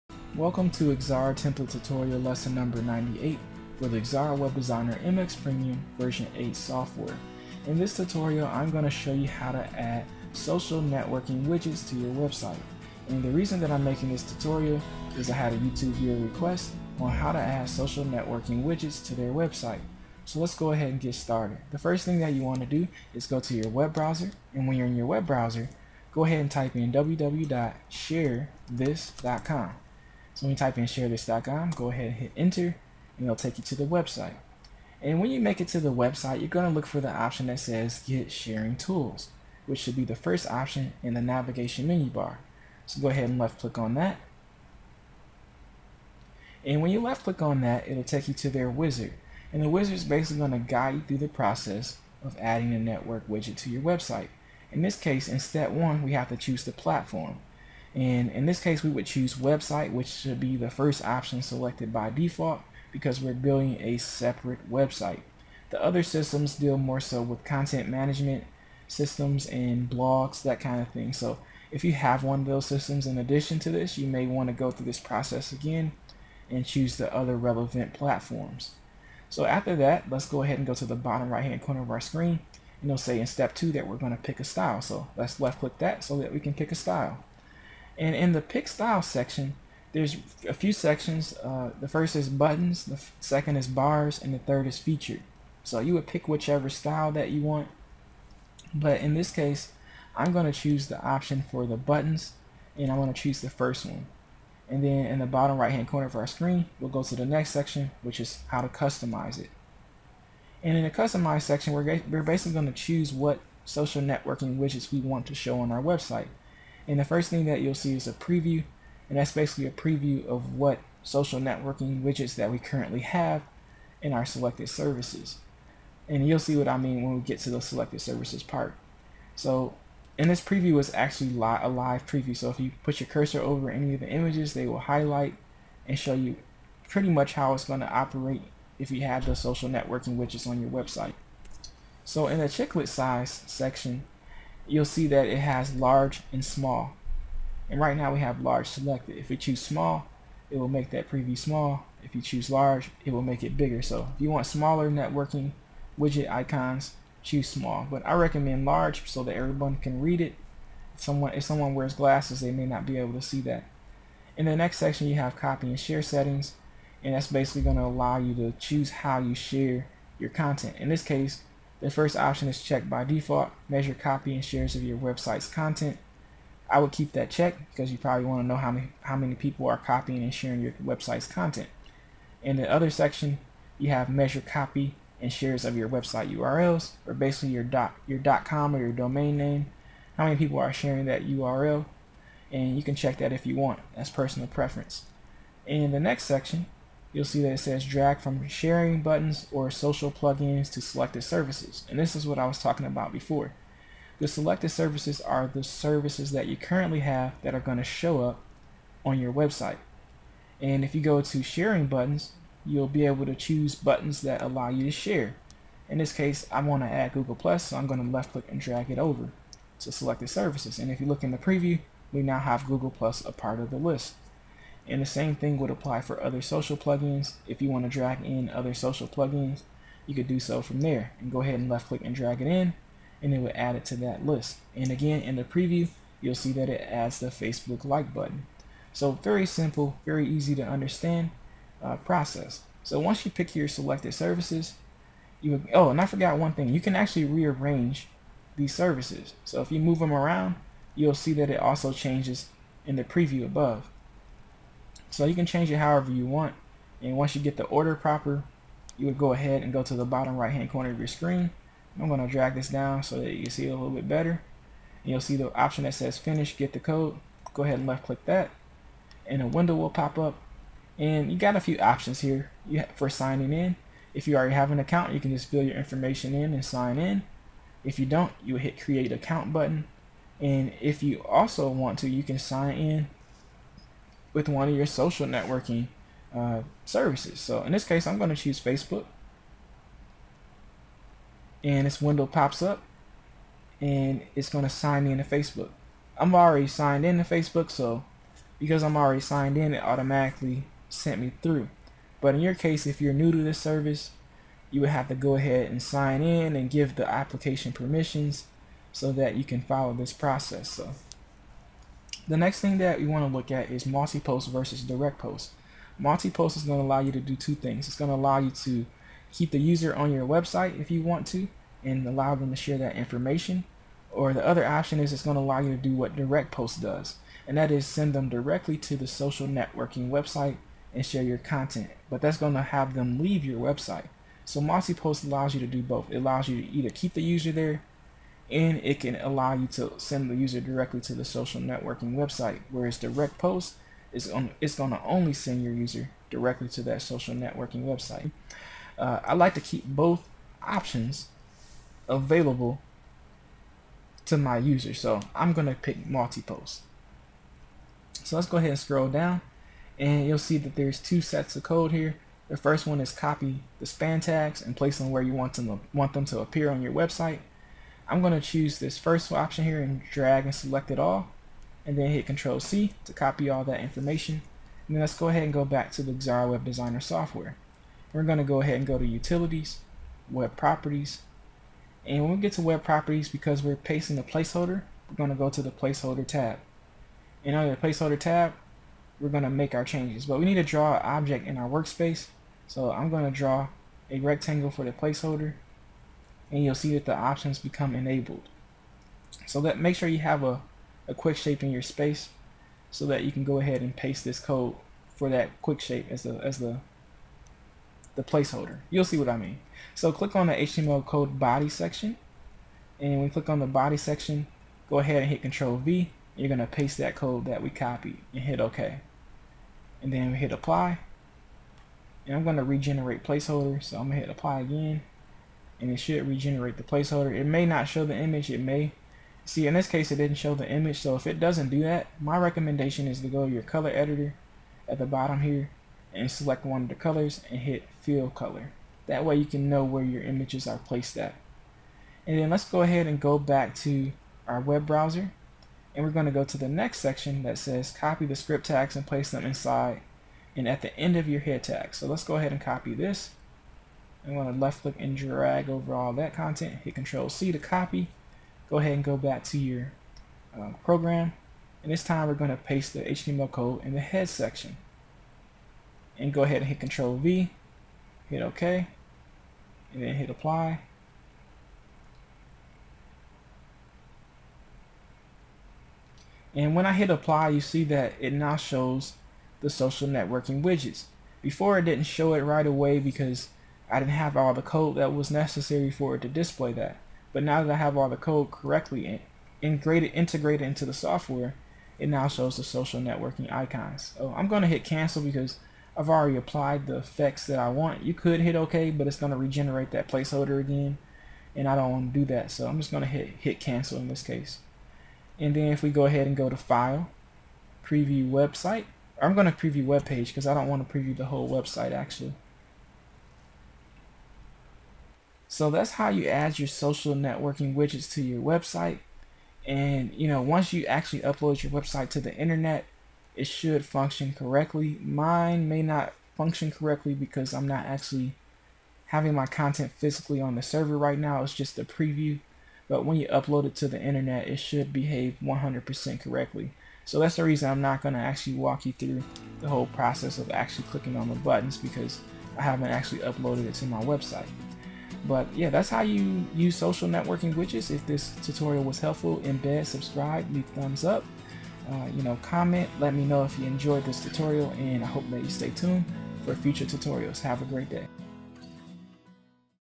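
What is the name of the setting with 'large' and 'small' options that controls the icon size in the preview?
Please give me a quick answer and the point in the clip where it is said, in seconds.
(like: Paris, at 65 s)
chiclet size, at 142 s.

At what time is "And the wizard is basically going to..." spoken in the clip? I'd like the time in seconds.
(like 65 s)
49 s.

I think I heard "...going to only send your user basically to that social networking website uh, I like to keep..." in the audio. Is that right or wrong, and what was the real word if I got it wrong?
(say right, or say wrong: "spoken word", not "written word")
wrong: "directly", not "basically".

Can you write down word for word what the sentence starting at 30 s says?
So when you type in sharethis.com, go ahead and hit enter, and it'll take you to the website.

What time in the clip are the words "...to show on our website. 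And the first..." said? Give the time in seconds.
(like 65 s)
115 s.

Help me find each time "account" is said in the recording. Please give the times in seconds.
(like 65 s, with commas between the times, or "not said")
274 s, 279 s.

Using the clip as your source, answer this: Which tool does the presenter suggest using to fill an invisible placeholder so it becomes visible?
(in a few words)
color editor.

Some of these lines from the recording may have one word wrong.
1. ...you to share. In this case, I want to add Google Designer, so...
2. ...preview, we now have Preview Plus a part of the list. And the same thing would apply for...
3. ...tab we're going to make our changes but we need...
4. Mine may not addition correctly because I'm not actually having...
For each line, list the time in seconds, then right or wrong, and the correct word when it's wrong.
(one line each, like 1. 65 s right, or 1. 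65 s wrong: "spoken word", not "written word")
1. 214 s wrong: "Plus", not "Designer"
2. 221 s wrong: "Google", not "Preview"
3. 388 s right
4. 525 s wrong: "function", not "addition".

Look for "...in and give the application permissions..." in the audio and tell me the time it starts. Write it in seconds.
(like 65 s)
306 s.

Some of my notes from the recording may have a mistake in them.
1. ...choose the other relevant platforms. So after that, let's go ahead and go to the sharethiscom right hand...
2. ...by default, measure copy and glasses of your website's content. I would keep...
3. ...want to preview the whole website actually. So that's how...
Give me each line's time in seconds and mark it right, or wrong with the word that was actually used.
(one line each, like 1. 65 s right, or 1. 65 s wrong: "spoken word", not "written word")
1. 76 s wrong: "bottom", not "sharethiscom"
2. 172 s wrong: "shares", not "glasses"
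3. 510 s right.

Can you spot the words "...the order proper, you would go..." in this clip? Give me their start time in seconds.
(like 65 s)
257 s.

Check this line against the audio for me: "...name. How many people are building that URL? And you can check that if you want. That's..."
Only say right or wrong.
wrong.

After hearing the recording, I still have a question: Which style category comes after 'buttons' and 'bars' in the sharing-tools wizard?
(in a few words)
featured.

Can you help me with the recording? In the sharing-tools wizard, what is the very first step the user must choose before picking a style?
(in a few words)
the platform.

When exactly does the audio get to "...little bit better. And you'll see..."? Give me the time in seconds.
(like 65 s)
263 s.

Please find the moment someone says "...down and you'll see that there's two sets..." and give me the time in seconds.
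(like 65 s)
359 s.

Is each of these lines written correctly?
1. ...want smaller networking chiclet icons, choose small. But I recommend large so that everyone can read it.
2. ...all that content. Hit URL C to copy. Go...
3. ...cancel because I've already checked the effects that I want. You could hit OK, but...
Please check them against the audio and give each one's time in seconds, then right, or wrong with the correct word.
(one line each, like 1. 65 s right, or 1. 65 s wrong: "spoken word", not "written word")
1. 154 s wrong: "widget", not "chiclet"
2. 455 s wrong: "Control", not "URL"
3. 494 s wrong: "applied", not "checked".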